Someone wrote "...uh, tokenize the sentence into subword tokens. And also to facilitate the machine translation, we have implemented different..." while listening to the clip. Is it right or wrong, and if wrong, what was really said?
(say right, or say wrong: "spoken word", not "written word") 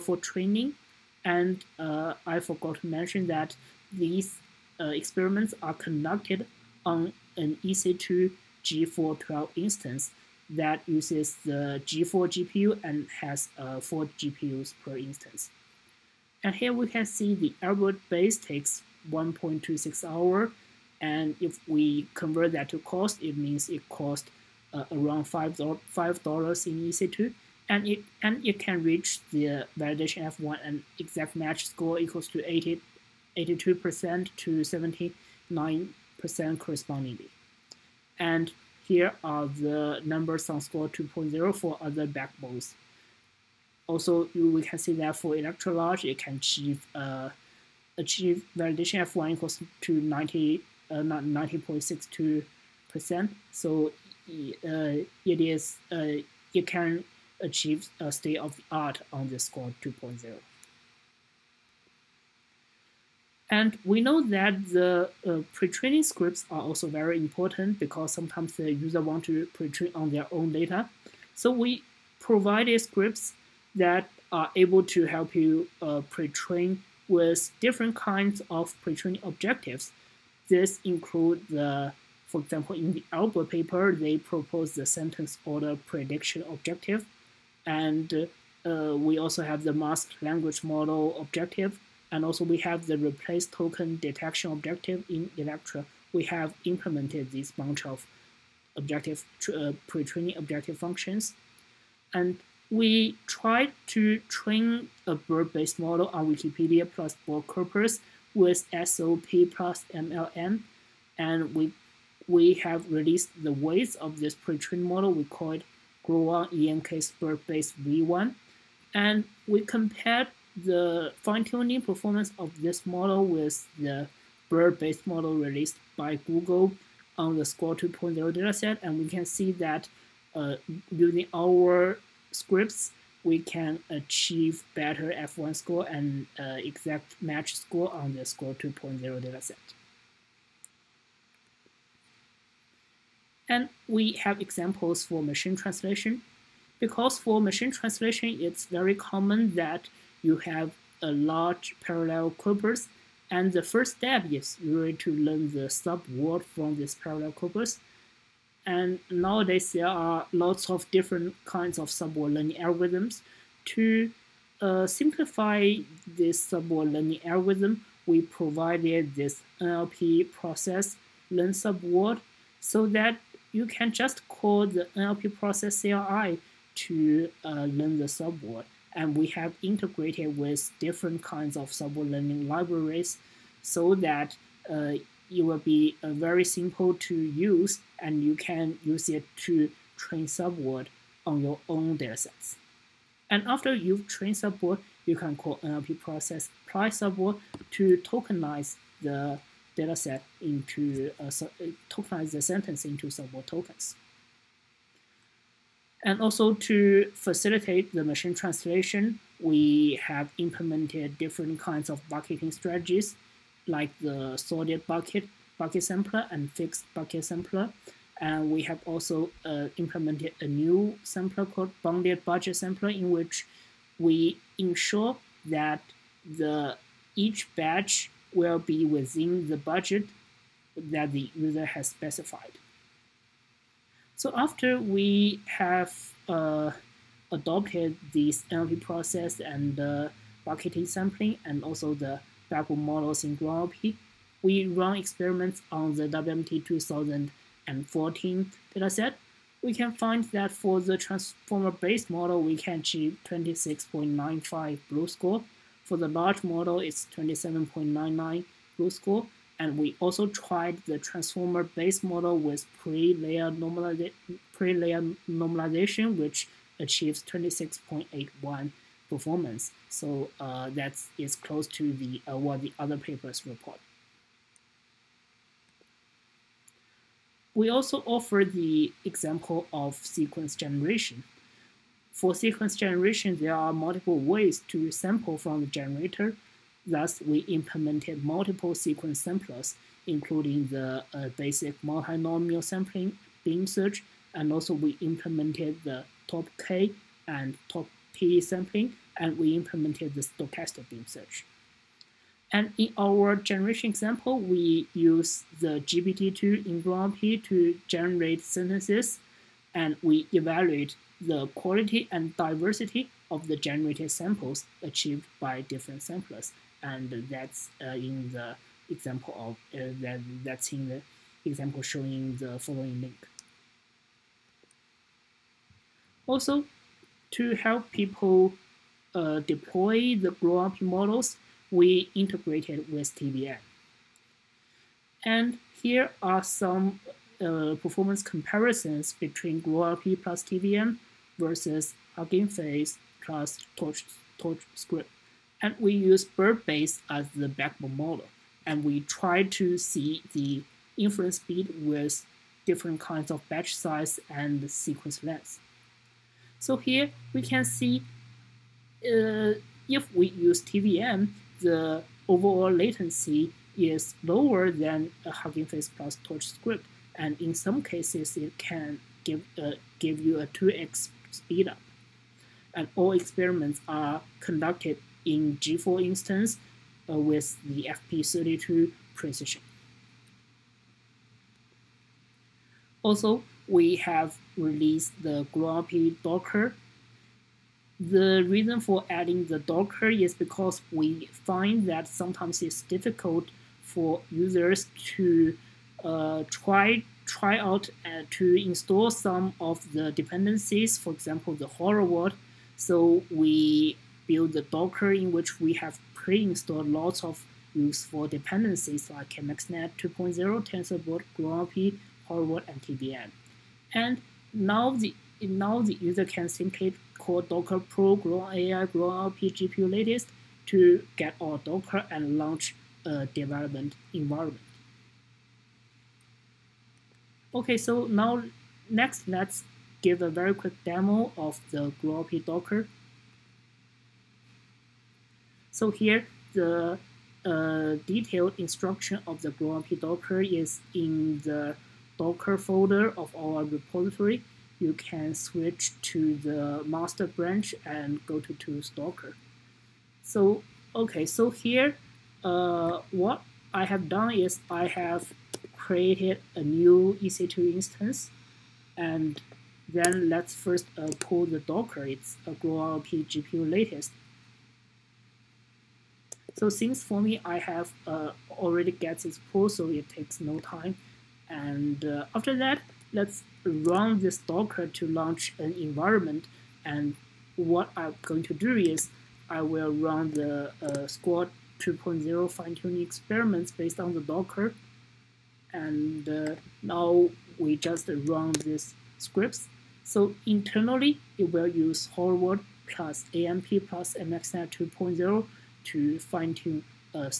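right.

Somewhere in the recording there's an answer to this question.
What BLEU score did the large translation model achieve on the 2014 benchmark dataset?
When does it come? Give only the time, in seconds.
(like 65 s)
257 s.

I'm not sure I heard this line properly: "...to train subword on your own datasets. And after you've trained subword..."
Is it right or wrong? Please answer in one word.
right.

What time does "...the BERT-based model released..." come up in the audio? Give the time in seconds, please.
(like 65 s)
123 s.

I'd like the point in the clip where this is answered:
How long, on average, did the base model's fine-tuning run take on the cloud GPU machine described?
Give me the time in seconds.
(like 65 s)
19 s.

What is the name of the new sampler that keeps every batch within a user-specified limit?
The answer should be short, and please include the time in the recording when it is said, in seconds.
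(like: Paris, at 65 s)
bounded budget sampler, at 221 s.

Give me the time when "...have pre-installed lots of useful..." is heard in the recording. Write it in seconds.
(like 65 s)
405 s.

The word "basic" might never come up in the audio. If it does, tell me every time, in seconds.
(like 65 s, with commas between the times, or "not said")
291 s.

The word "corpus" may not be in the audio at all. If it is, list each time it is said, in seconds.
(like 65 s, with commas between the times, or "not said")
107 s, 152 s, 157 s.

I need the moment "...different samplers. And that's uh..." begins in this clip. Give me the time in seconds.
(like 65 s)
315 s.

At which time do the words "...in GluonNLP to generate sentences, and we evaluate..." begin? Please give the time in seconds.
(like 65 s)
306 s.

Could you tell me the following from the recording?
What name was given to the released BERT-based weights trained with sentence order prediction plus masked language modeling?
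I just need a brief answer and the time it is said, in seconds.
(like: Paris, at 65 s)
Gluon ENK's BERT-based V1, at 116 s.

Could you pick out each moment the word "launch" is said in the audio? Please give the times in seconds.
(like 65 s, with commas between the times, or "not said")
422 s, 475 s.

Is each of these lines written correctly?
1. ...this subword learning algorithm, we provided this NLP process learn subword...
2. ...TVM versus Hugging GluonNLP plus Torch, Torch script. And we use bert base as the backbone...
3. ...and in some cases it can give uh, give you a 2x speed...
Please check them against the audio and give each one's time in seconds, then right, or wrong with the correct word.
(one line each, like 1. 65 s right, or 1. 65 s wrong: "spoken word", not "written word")
1. 166 s right
2. 340 s wrong: "Face", not "GluonNLP"
3. 367 s right.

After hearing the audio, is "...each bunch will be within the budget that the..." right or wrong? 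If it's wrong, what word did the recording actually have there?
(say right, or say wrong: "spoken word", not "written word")
wrong: "batch", not "bunch".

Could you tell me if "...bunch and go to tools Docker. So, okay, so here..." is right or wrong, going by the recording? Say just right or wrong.
wrong.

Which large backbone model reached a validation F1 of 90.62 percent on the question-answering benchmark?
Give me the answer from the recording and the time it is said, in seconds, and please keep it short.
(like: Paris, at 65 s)
Electra large, at 45 s.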